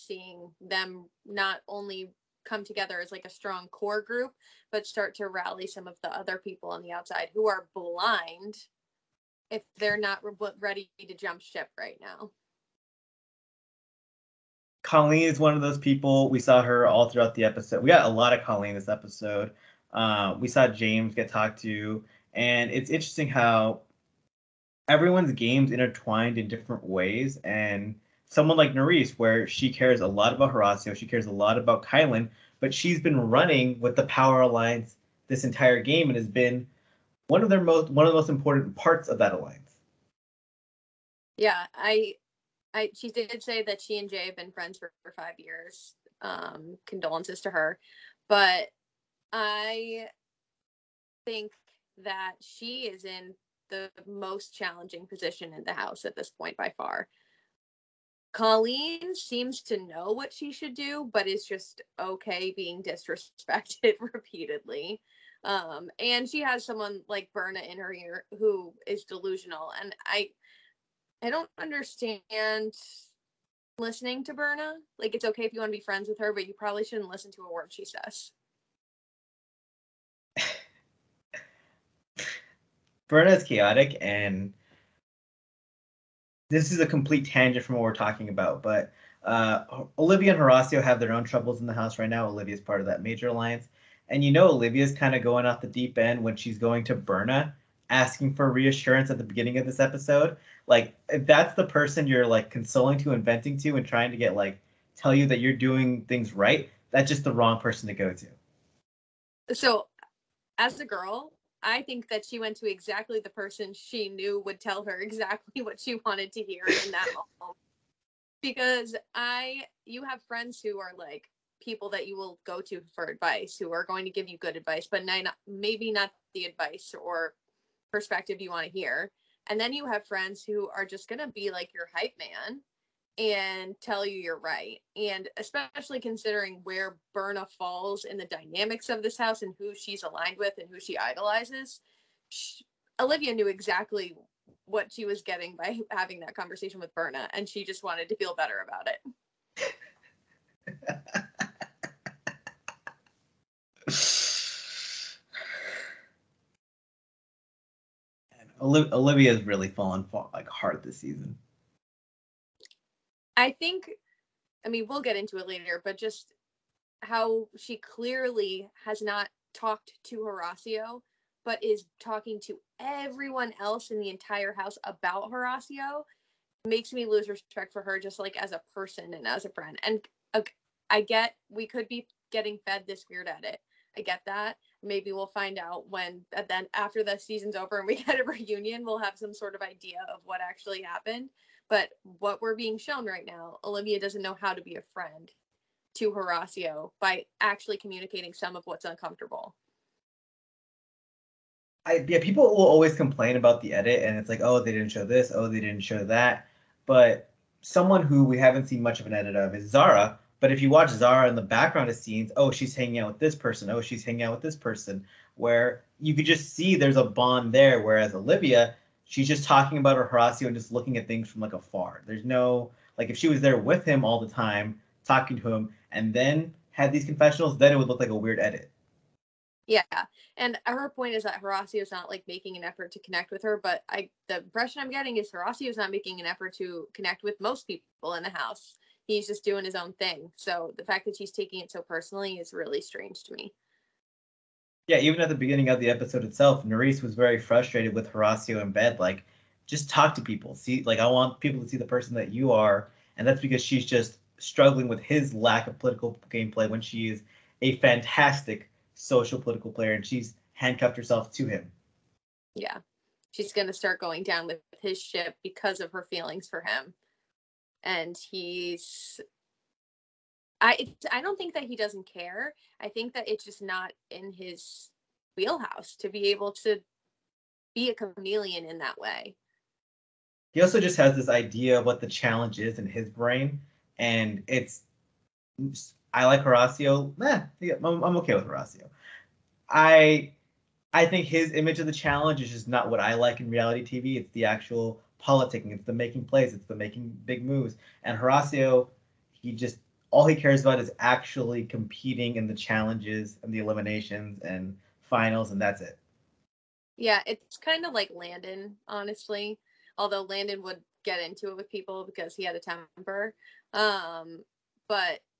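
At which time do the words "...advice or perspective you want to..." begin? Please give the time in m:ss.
2:06.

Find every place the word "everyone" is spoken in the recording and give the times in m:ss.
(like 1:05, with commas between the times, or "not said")
0:24, 2:52.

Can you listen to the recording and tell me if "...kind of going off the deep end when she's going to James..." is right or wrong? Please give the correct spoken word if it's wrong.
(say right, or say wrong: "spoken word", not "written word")
wrong: "Berna", not "James".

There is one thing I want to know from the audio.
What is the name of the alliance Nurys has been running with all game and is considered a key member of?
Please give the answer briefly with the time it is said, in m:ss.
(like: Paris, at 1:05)
Power Alliance, at 0:34.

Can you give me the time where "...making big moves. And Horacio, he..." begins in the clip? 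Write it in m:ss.
4:56.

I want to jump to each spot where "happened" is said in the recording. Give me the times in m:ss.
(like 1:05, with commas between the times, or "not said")
3:10.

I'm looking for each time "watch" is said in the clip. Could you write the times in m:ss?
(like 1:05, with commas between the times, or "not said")
3:30.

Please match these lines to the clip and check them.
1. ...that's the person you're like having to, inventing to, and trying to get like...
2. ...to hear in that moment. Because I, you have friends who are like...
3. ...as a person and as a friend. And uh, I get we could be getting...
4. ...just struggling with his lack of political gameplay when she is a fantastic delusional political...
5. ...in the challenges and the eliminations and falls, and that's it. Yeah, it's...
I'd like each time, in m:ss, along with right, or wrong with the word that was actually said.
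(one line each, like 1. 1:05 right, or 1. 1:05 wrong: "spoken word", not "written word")
1. 1:41 wrong: "consoling", not "having"
2. 1:56 right
3. 2:58 right
4. 4:13 wrong: "social", not "delusional"
5. 5:02 wrong: "finals", not "falls".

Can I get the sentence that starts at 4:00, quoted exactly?
So the fact that he's taking it so personally is really strange to me.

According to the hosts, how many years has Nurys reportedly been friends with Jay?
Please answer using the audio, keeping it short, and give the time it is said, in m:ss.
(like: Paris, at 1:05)
5, at 0:45.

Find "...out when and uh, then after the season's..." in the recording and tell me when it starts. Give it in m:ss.
3:05.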